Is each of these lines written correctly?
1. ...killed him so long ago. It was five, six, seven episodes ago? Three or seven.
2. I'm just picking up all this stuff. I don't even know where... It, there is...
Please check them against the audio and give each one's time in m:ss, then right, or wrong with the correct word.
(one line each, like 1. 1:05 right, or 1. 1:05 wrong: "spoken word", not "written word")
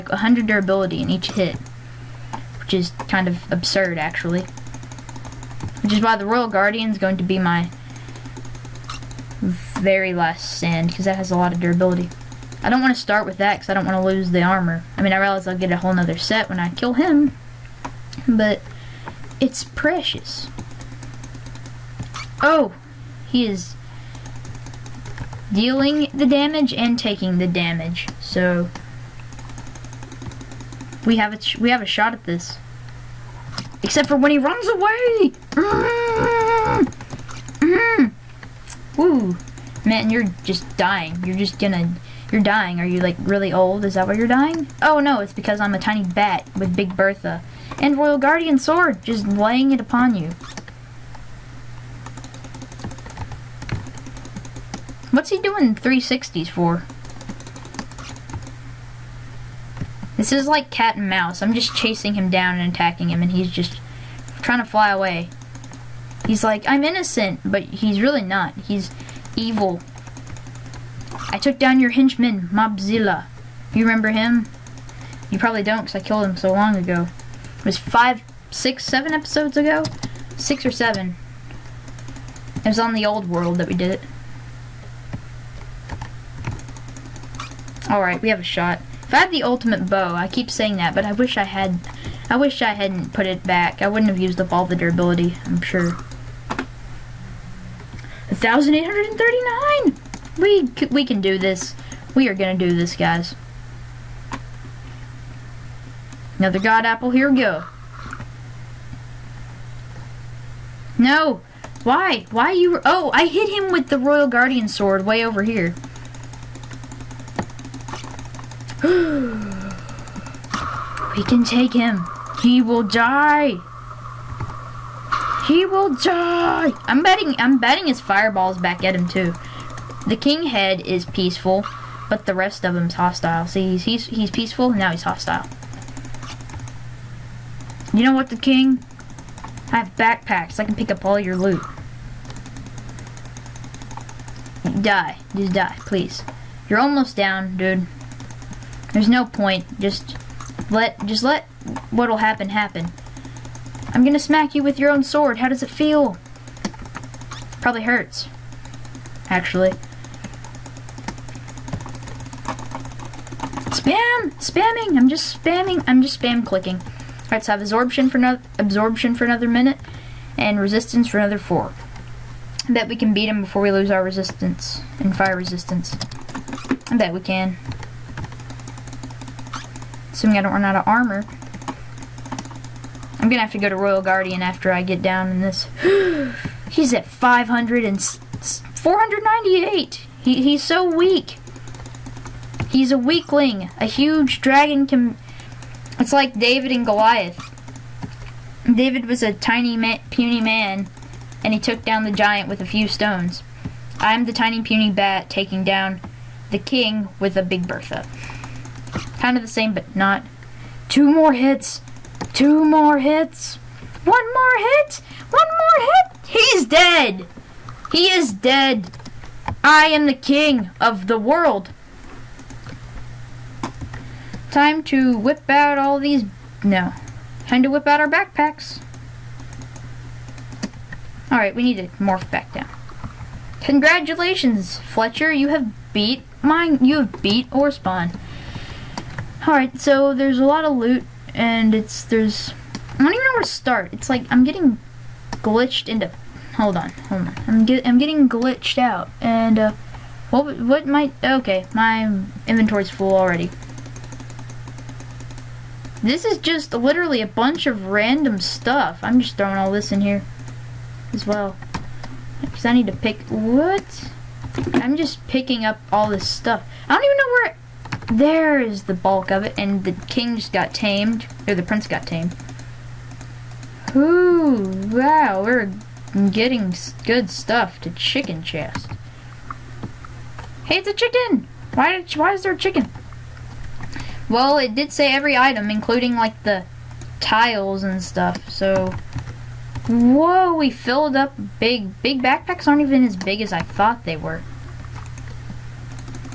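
1. 1:16 wrong: "Six", not "Three"
2. 4:24 right.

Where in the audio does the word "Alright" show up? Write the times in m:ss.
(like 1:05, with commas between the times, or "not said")
1:27, 2:47, 3:51, 3:59.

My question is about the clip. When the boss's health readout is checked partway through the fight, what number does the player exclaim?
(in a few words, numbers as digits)
1,839.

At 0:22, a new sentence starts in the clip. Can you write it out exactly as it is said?
Oh, he is dealing the damage and taking the damage.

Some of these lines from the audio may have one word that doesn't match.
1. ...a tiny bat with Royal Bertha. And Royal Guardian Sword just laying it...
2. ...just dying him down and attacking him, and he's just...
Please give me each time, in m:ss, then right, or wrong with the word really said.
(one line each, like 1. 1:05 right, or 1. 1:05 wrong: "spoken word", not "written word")
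1. 0:45 wrong: "Big", not "Royal"
2. 1:01 wrong: "chasing", not "dying".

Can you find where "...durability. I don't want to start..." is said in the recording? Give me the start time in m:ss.
0:11.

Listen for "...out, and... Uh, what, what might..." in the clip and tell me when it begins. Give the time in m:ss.
4:08.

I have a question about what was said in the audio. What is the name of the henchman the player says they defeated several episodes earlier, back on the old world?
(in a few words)
Mobzilla.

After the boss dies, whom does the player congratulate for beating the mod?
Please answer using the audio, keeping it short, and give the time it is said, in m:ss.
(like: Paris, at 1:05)
Fletcher, at 3:54.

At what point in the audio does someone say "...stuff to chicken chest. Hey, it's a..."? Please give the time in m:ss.
4:37.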